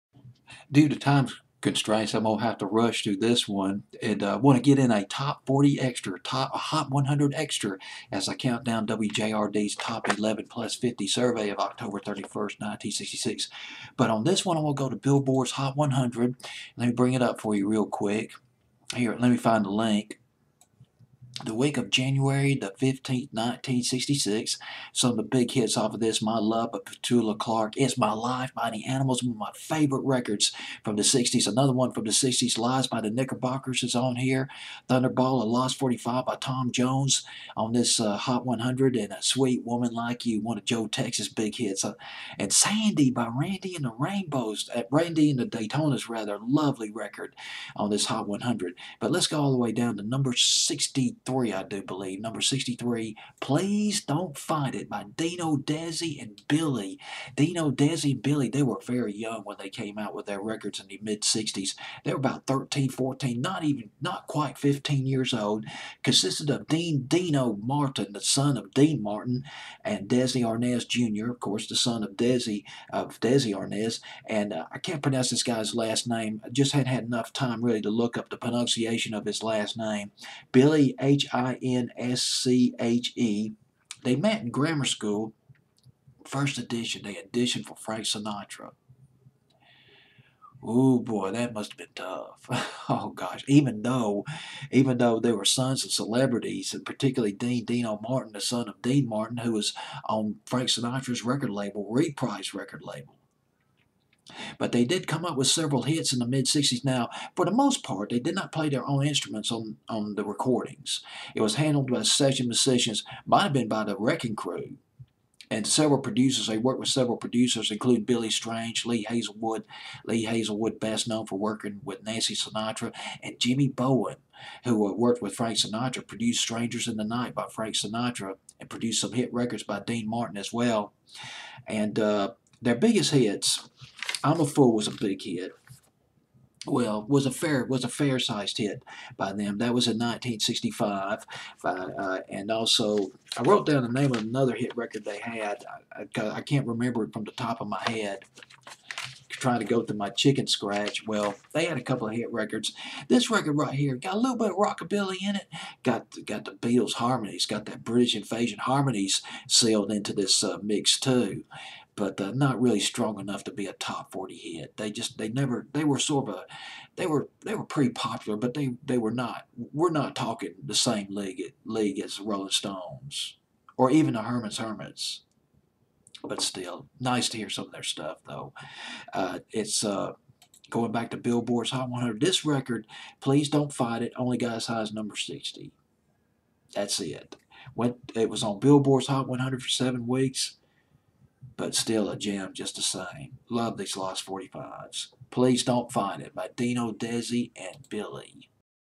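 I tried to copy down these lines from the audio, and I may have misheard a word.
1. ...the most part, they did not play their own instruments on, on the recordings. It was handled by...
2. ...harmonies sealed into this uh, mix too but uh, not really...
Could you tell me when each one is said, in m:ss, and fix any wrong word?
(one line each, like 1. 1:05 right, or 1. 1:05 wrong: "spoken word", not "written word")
1. 1:47 right
2. 2:38 right.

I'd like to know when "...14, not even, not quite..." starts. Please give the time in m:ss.
1:02.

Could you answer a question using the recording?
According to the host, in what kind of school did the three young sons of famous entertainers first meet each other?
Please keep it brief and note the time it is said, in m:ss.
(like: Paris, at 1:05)
grammar school, at 1:24.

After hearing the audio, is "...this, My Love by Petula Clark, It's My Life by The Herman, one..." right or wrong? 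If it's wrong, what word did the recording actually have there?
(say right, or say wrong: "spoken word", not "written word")
wrong: "Animals", not "Herman".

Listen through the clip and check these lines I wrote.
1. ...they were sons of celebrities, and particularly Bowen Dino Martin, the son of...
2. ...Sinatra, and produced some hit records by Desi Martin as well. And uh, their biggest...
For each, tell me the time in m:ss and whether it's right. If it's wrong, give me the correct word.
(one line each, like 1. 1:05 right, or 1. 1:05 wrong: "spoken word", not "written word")
1. 1:35 wrong: "Dean", not "Bowen"
2. 2:07 wrong: "Dean", not "Desi".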